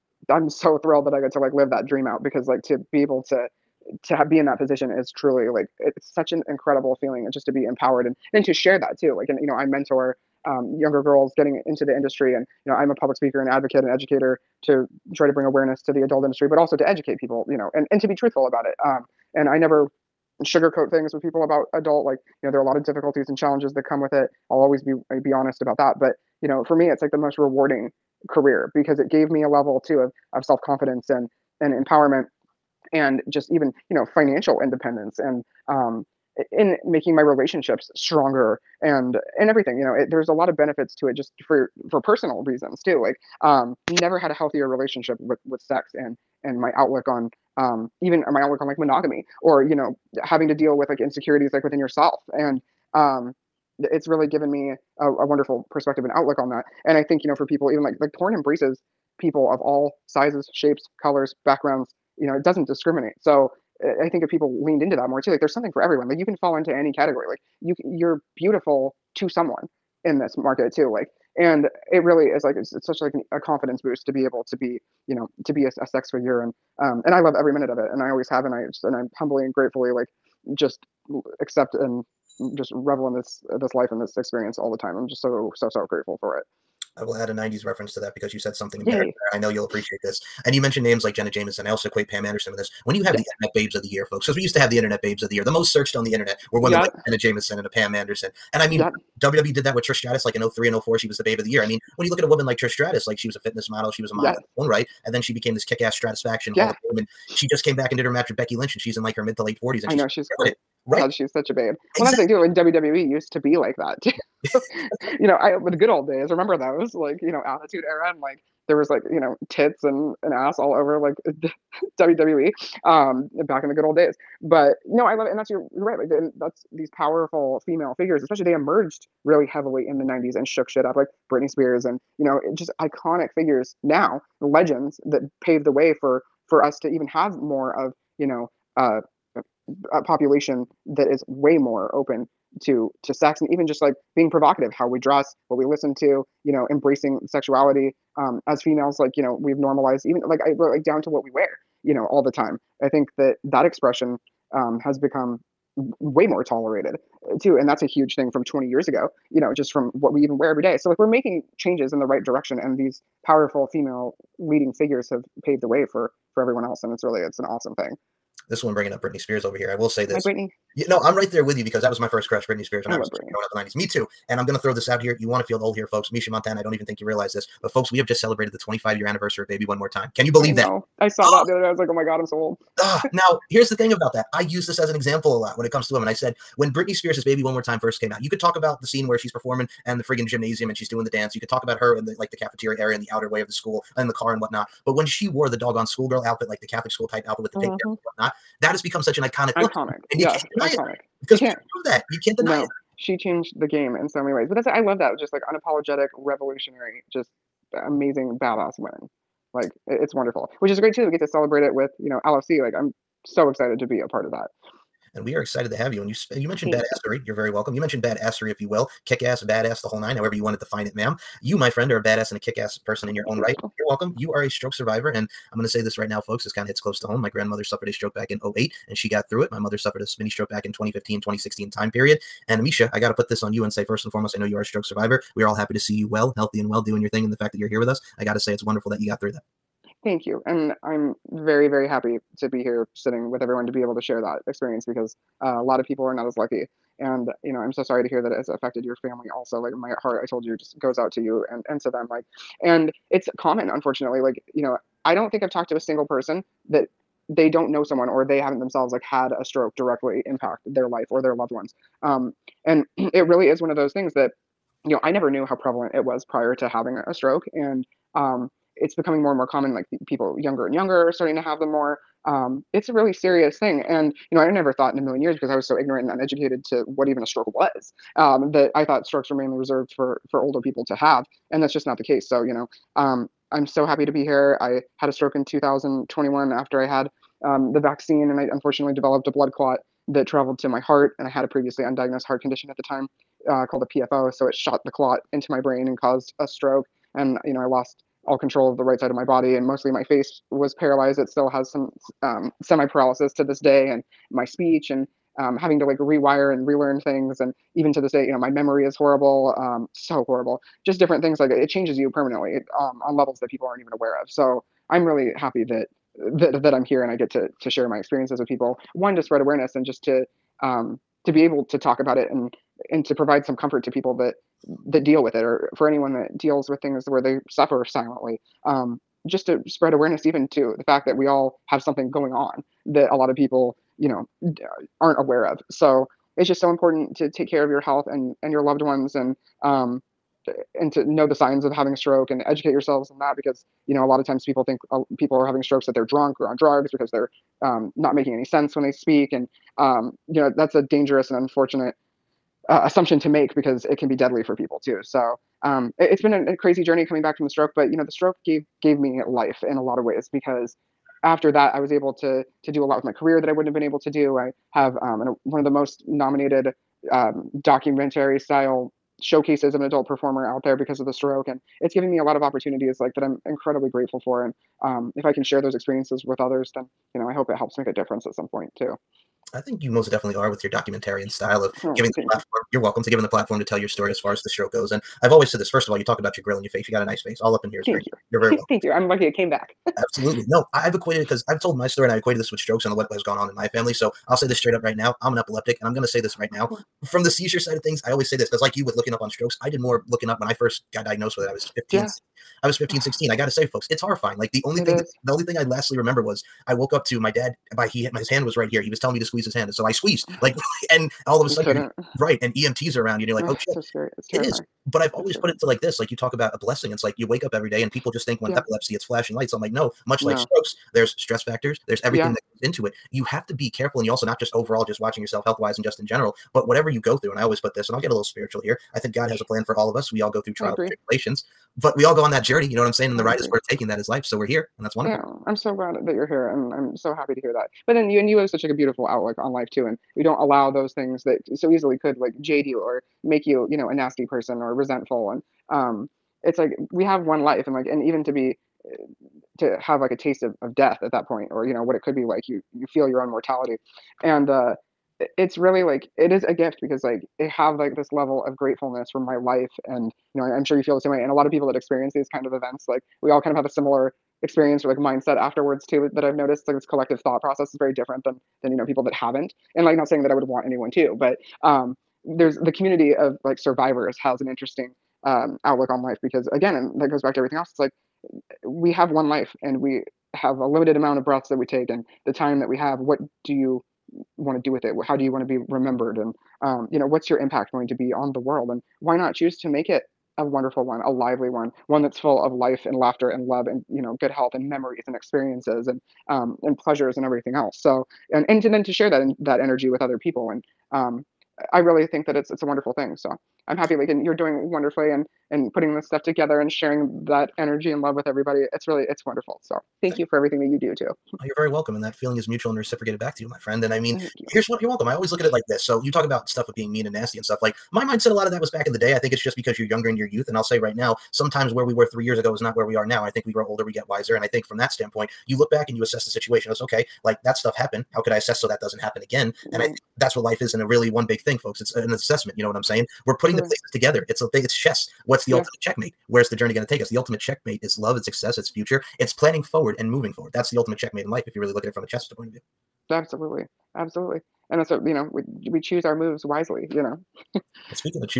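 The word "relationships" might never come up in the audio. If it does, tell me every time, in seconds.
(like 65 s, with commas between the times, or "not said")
37 s, 44 s.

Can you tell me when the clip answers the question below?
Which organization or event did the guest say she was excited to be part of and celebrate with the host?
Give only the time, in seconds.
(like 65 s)
212 s.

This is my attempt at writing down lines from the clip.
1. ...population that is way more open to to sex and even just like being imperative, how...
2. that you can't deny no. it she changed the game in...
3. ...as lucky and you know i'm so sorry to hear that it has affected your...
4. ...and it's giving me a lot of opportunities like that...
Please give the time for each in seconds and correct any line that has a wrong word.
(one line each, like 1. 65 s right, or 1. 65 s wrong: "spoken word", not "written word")
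1. 140 s wrong: "provocative", not "imperative"
2. 201 s right
3. 246 s right
4. 371 s right.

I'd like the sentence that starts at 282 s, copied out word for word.
So you know, um, I'm so happy to be here.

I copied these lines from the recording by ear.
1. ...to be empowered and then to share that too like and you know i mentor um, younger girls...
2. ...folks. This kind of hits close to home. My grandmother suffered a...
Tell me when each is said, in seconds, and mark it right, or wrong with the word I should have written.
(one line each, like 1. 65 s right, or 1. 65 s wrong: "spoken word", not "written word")
1. 7 s right
2. 226 s right.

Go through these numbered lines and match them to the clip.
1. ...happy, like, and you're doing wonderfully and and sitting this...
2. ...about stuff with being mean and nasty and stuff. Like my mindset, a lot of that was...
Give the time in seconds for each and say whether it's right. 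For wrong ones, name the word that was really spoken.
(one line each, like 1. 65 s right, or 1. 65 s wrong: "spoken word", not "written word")
1. 503 s wrong: "putting", not "sitting"
2. 516 s right.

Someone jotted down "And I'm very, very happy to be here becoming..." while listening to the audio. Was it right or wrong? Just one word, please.
wrong.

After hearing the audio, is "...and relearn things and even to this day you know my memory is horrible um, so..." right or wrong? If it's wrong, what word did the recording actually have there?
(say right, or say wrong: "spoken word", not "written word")
right.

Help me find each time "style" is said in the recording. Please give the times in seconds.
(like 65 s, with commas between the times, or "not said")
368 s, 381 s.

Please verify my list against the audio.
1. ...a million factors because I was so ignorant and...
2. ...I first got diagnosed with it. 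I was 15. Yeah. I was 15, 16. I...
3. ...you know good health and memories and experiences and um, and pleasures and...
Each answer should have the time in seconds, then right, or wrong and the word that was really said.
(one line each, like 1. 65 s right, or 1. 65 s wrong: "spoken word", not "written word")
1. 274 s wrong: "years", not "factors"
2. 400 s right
3. 493 s right.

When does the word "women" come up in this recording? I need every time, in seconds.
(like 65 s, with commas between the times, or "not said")
96 s, 185 s, 208 s.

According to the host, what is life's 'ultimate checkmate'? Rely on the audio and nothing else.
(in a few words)
love and success.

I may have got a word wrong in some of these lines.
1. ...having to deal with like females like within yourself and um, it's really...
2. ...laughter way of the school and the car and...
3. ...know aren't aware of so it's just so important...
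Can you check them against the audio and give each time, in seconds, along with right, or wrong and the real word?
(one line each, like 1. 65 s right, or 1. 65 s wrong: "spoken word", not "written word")
1. 50 s wrong: "insecurities", not "females"
2. 193 s wrong: "outer", not "laughter"
3. 334 s right.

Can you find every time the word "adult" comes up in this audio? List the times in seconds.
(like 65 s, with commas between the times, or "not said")
16 s, 21 s, 369 s.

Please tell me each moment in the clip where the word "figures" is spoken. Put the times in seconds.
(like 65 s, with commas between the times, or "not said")
76 s, 127 s, 133 s, 164 s.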